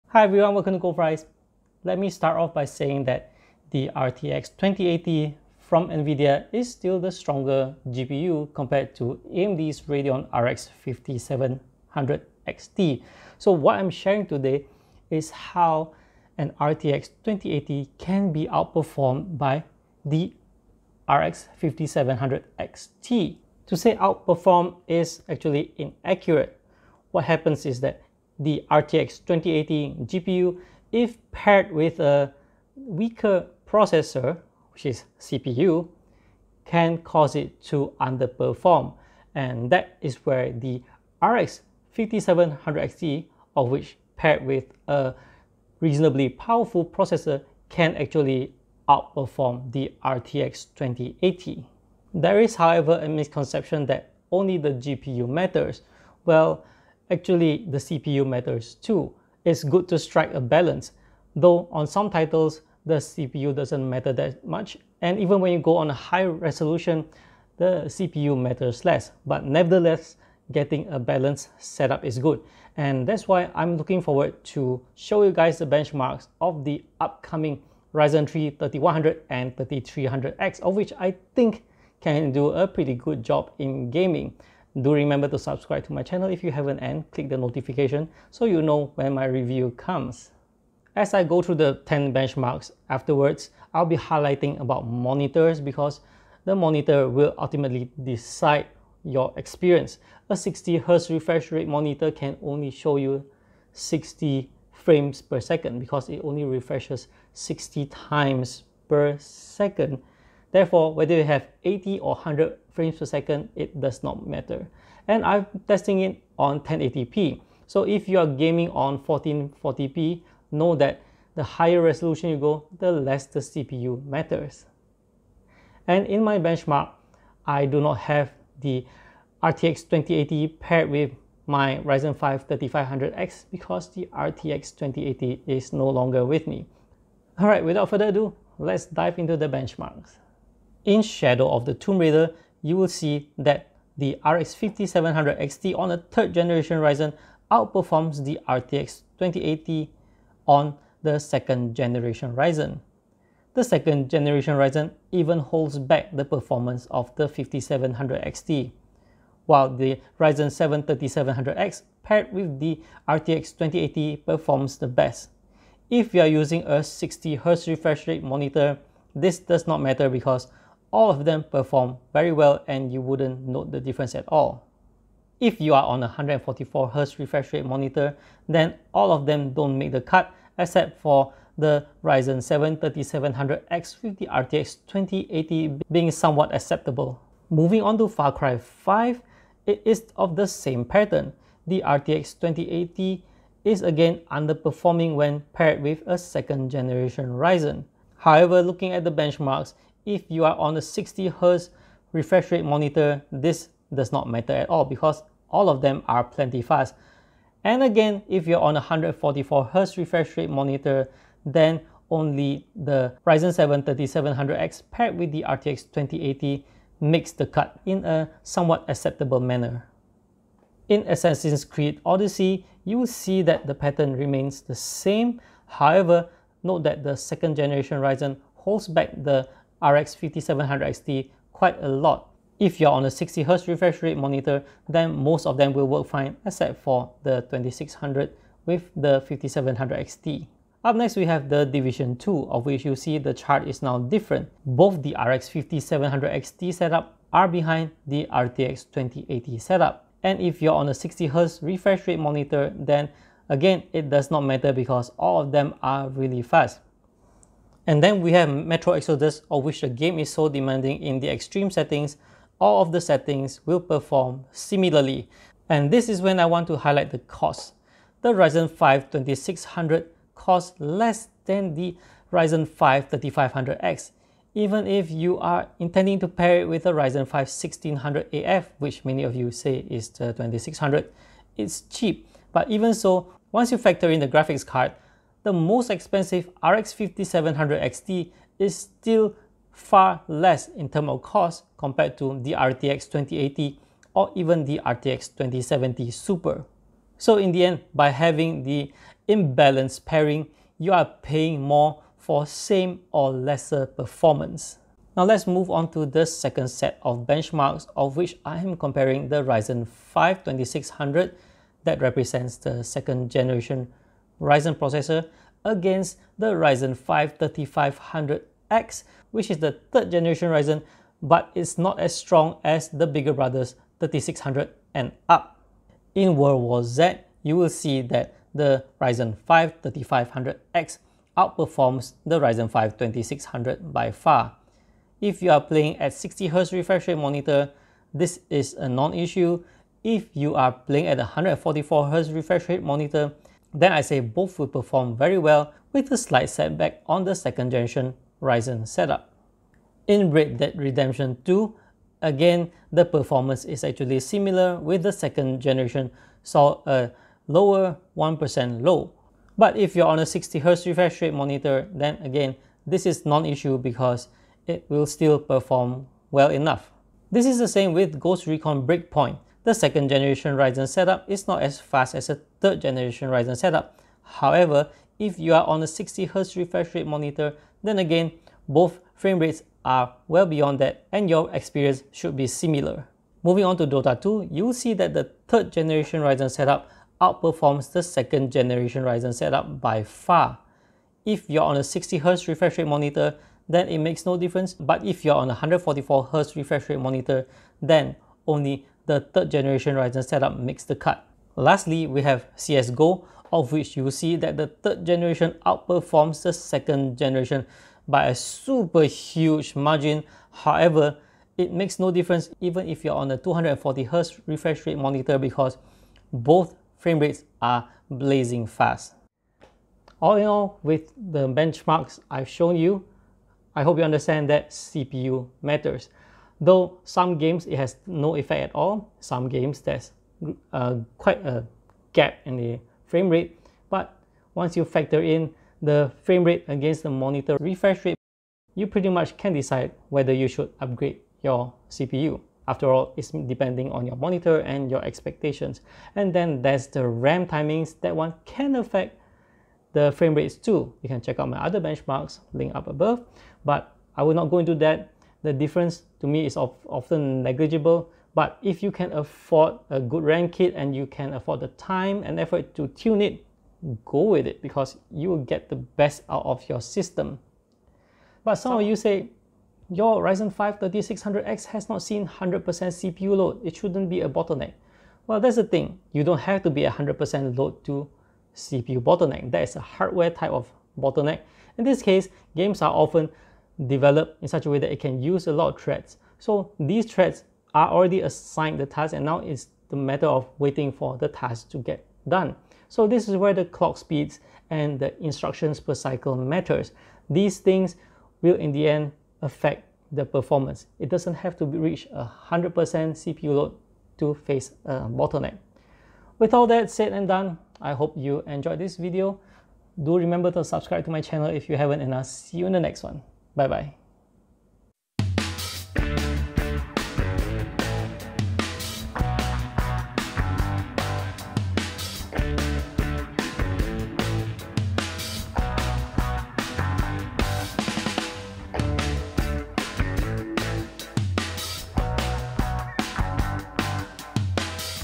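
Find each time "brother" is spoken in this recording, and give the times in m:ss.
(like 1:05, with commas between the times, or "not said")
5:23.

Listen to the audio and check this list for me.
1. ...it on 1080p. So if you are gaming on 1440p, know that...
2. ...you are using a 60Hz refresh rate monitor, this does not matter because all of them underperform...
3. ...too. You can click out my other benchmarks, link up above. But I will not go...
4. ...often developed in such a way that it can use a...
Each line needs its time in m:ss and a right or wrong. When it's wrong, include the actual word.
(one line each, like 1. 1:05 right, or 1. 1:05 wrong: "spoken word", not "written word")
1. 1:56 right
2. 2:46 wrong: "perform", not "underperform"
3. 7:30 wrong: "check", not "click"
4. 8:02 right.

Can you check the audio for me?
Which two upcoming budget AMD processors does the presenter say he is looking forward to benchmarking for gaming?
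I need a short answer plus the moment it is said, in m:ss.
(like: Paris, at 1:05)
Ryzen 3 3100 and 3300X, at 1:17.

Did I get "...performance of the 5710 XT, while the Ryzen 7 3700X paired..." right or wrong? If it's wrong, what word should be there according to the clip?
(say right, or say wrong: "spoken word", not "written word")
wrong: "5700", not "5710".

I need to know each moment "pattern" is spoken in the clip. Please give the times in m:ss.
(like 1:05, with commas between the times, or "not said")
3:10, 3:43.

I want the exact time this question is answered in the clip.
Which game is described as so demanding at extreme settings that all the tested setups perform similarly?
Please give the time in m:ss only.
4:18.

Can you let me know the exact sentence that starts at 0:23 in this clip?
To say outperform is actually inaccurate.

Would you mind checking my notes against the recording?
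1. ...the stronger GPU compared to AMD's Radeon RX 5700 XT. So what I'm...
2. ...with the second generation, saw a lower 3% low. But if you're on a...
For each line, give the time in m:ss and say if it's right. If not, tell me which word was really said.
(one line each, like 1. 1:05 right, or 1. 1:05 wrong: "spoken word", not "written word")
1. 0:06 right
2. 5:54 wrong: "1", not "3".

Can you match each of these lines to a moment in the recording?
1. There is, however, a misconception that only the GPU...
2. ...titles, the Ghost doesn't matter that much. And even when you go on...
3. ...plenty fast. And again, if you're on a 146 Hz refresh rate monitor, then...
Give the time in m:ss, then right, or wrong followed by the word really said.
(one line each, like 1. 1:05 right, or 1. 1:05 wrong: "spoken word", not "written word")
1. 0:52 right
2. 1:02 wrong: "CPU", not "Ghost"
3. 3:26 wrong: "144", not "146".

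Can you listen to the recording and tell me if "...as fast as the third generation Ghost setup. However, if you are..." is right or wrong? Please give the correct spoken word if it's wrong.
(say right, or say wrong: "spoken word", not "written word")
wrong: "Ryzen", not "Ghost".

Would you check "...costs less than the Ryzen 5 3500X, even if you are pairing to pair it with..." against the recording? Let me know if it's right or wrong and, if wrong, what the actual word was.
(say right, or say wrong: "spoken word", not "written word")
wrong: "intending", not "pairing".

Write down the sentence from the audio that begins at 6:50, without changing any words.
However, it makes no difference even if you're on a 240Hz refresh rate monitor because both frame rates are blazing fast.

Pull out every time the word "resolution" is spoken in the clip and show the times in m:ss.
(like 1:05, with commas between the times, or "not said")
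1:06, 2:01.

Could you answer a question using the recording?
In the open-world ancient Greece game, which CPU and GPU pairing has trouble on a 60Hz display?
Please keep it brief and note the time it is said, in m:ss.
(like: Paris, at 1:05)
2600 with the 5700 XT, at 3:57.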